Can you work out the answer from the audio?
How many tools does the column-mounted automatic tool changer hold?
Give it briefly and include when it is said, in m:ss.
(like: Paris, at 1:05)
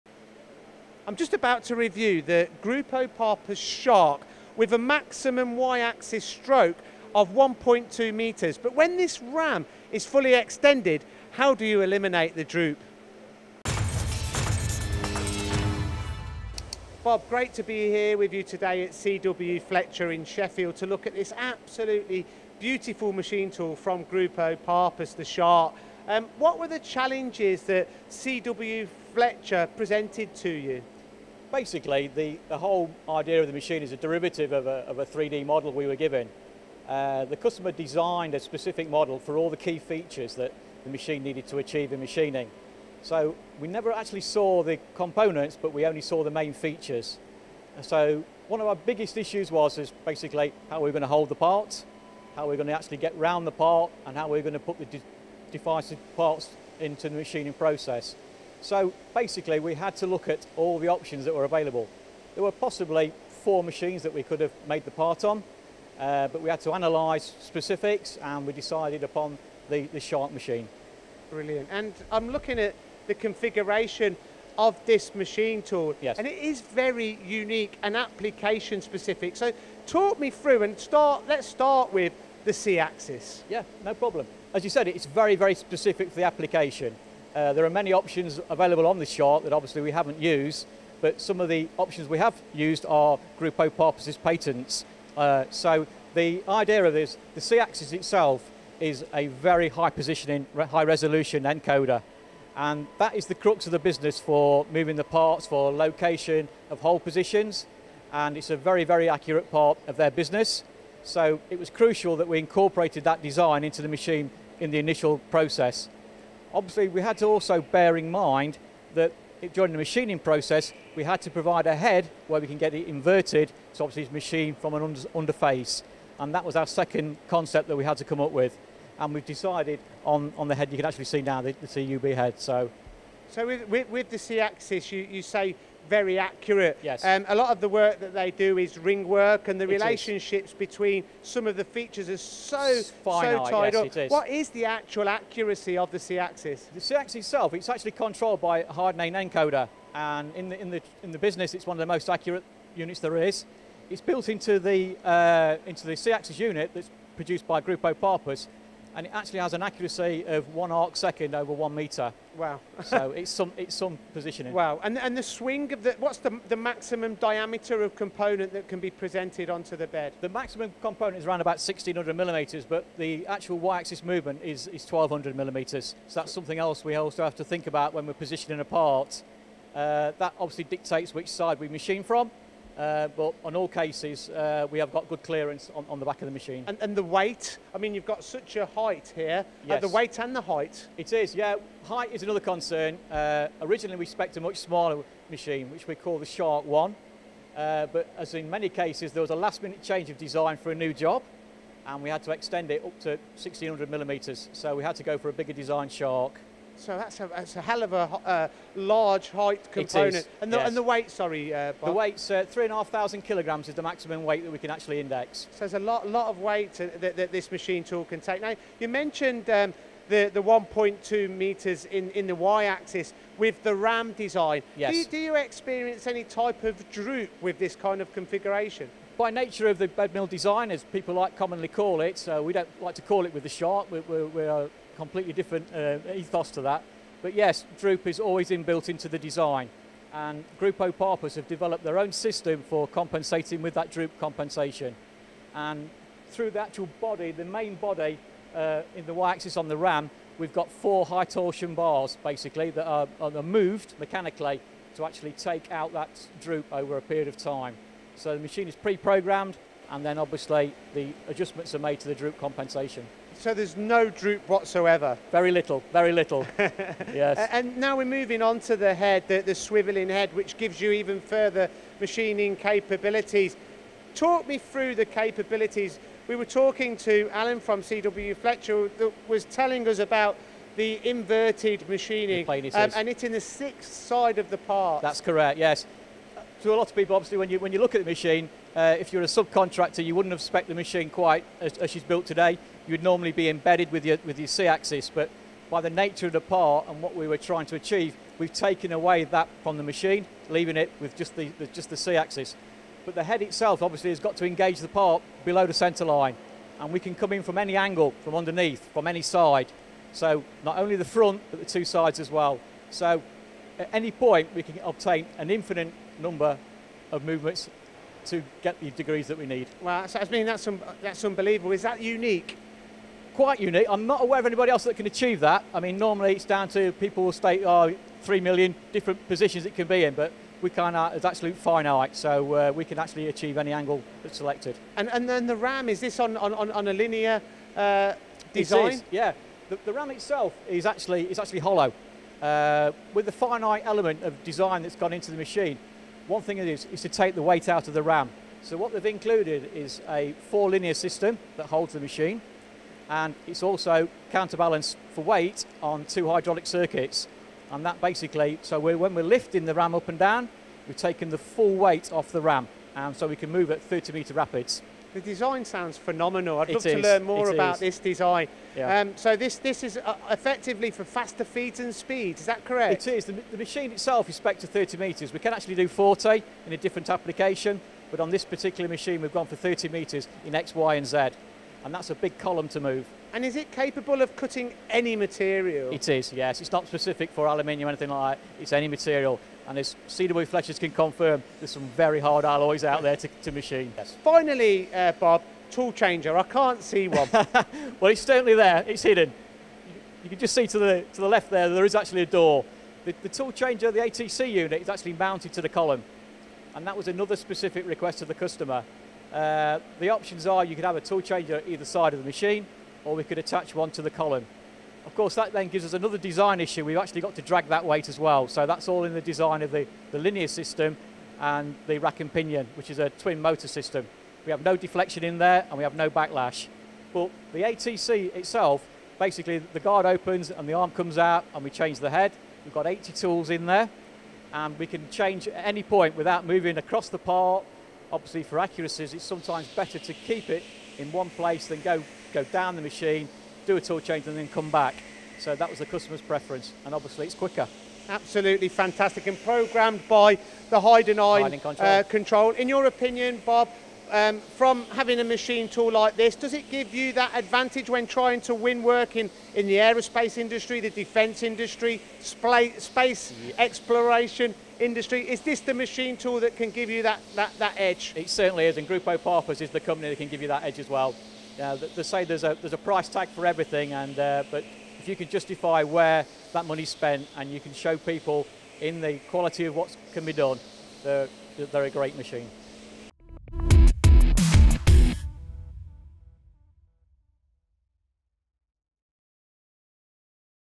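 80, at 7:12.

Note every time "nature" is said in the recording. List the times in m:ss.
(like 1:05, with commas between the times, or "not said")
3:49, 4:55.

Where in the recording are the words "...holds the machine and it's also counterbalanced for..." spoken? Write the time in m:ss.
5:51.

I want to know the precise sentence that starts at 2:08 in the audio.
And we've decided on, on the head, you can actually see now the, the CUB head, so.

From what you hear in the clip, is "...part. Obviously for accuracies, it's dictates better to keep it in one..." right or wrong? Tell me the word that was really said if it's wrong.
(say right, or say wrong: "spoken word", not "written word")
wrong: "sometimes", not "dictates".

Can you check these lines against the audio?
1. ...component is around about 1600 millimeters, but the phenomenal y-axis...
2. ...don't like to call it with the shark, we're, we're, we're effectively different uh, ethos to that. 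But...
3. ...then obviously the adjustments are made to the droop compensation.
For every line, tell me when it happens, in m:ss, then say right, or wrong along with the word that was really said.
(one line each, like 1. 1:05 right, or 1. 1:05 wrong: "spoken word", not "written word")
1. 2:50 wrong: "actual", not "phenomenal"
2. 3:52 wrong: "completely", not "effectively"
3. 4:20 right.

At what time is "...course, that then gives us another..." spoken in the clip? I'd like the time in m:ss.
6:55.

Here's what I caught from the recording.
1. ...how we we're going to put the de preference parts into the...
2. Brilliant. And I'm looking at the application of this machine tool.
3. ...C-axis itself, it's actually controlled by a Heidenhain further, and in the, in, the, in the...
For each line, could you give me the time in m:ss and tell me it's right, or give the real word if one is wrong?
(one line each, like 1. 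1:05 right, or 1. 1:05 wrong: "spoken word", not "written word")
1. 0:54 wrong: "device", not "preference"
2. 1:11 wrong: "configuration", not "application"
3. 2:26 wrong: "encoder", not "further".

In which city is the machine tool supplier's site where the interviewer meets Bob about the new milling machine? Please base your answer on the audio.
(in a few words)
Sheffield.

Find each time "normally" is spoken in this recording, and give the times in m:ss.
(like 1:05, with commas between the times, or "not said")
4:53, 5:25.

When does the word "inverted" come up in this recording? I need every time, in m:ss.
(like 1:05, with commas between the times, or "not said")
2:02, 4:41.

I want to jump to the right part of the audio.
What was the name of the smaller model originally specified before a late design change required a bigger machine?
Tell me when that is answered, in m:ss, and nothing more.
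3:16.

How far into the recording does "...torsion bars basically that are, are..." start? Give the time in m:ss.
4:11.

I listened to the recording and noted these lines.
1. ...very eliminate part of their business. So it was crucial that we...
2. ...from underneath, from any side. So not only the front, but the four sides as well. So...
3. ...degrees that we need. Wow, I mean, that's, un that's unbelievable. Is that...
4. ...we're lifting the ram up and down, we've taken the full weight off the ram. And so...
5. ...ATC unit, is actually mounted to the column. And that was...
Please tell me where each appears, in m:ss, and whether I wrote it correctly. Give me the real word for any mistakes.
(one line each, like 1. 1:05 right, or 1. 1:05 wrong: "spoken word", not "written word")
1. 1:48 wrong: "accurate", not "eliminate"
2. 5:08 wrong: "two", not "four"
3. 5:18 right
4. 5:59 right
5. 6:43 right.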